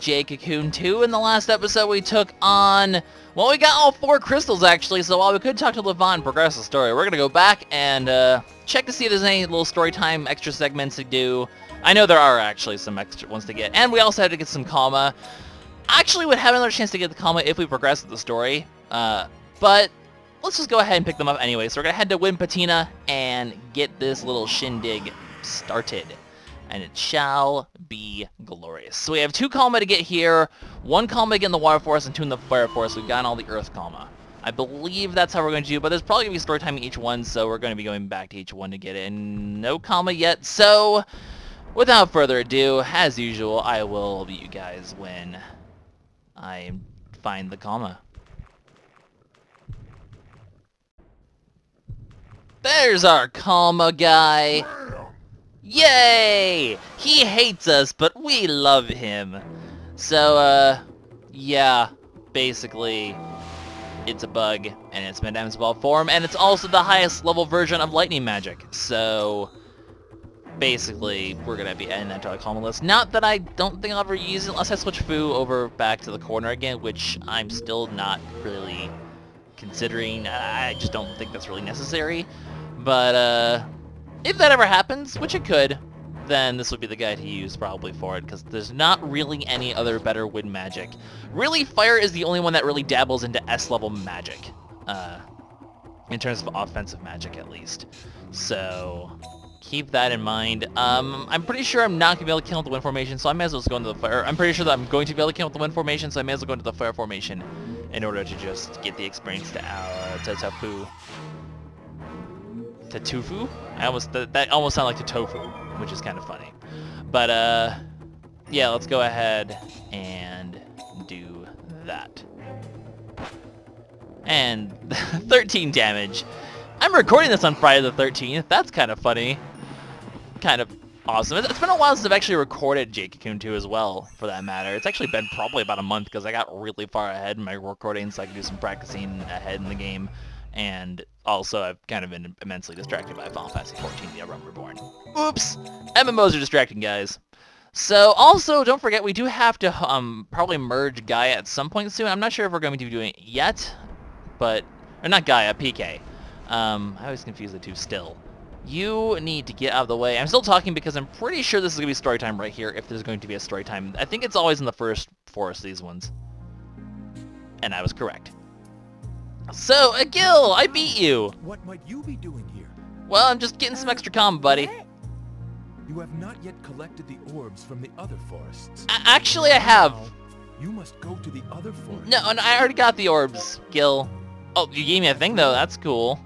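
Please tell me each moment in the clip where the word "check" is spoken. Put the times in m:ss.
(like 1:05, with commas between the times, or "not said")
0:08.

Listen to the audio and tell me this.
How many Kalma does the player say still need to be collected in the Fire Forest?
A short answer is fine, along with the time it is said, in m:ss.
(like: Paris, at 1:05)
2, at 0:32.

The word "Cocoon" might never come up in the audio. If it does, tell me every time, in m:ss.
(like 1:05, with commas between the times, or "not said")
0:00, 2:13.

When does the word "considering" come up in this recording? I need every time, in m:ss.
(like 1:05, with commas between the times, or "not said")
1:19.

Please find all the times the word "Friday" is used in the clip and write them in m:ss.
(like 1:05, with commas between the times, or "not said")
2:07.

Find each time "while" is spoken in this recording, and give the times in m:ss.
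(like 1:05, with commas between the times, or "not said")
0:05, 2:11.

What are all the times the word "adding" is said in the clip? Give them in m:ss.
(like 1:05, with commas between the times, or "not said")
1:11.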